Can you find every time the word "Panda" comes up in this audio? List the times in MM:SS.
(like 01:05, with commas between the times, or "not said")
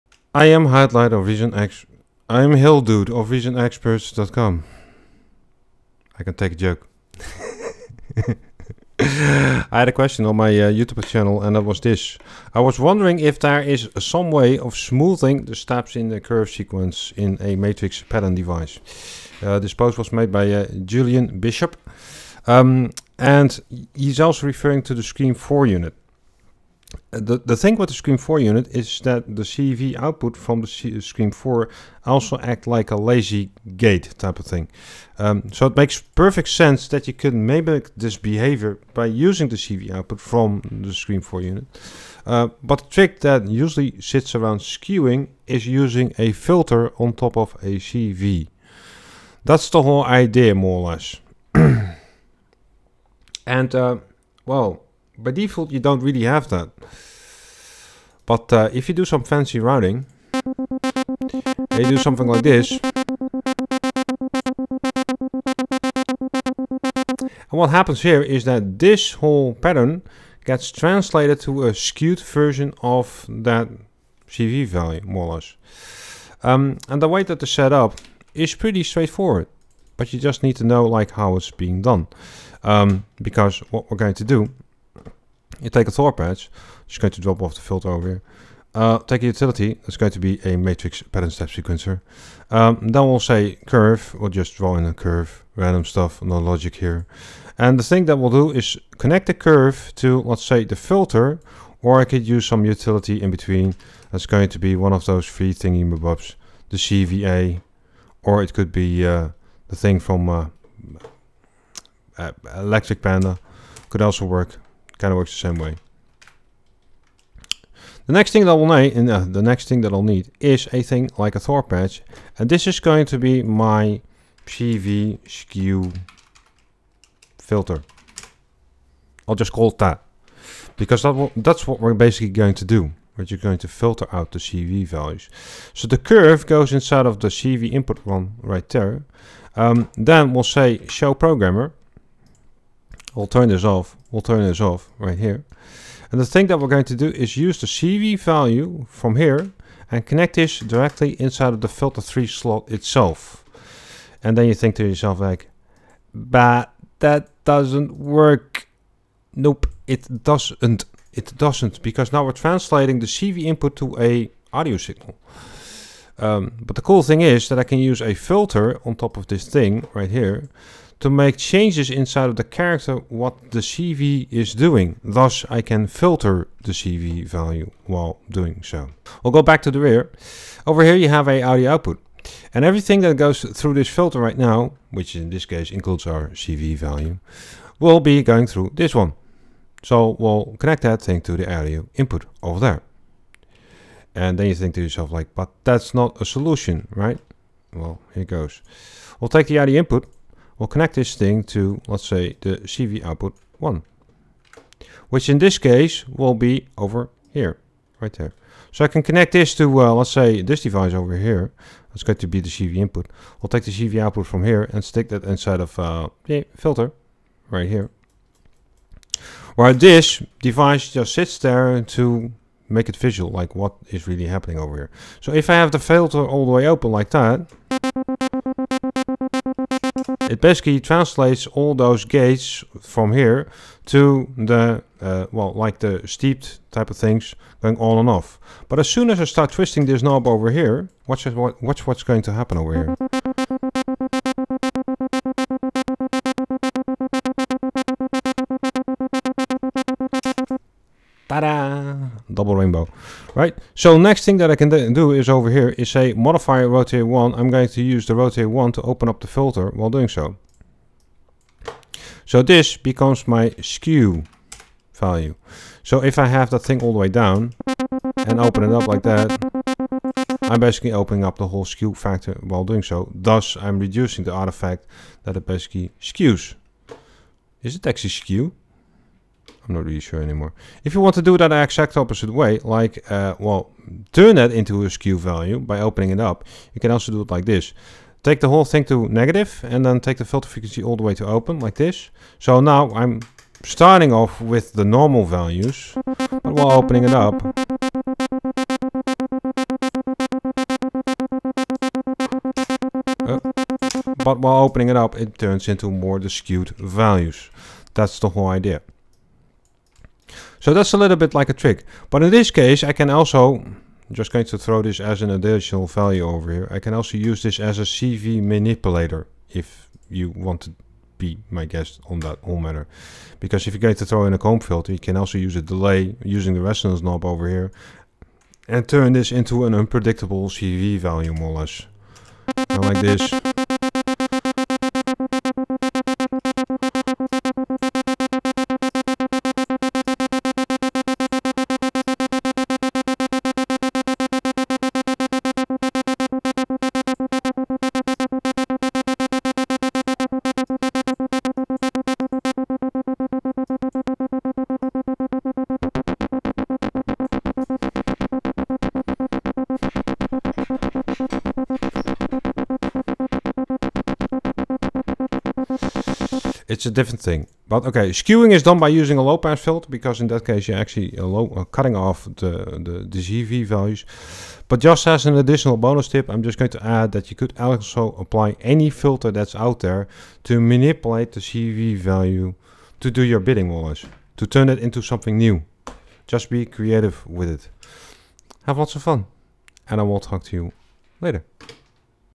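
01:53.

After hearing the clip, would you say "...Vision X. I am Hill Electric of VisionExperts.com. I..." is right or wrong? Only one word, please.
wrong.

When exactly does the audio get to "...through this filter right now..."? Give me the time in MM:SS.
03:03.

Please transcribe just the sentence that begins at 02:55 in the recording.
Thus, I can filter the CV value while doing so.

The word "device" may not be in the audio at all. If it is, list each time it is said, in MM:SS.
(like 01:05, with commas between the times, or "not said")
00:18, 03:30, 03:40.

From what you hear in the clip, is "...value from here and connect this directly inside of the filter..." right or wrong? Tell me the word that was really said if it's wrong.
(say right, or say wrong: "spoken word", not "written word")
right.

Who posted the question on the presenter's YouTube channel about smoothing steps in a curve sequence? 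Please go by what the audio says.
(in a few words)
Julian Bishop.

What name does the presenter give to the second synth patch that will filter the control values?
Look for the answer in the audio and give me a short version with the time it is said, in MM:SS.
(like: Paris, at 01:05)
CV skew filter, at 02:04.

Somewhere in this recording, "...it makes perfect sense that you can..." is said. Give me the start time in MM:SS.
00:35.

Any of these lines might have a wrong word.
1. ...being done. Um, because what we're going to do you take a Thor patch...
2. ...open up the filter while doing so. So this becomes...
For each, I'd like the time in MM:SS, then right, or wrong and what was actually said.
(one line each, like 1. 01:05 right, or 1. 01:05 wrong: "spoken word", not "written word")
1. 01:21 right
2. 04:18 right.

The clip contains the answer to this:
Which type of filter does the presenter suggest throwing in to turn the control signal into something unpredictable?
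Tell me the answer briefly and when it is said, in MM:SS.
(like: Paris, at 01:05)
comb filter, at 05:24.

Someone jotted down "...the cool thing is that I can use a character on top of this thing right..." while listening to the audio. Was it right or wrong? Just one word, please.
wrong.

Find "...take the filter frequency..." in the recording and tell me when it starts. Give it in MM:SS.
04:49.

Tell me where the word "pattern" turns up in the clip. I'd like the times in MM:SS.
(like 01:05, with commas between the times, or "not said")
00:18, 01:09, 01:31.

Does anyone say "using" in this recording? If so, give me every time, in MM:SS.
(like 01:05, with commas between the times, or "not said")
00:39, 00:45, 05:26, 06:09.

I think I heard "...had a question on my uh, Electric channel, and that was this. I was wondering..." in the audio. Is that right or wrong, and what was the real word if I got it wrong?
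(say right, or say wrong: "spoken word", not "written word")
wrong: "YouTube", not "Electric".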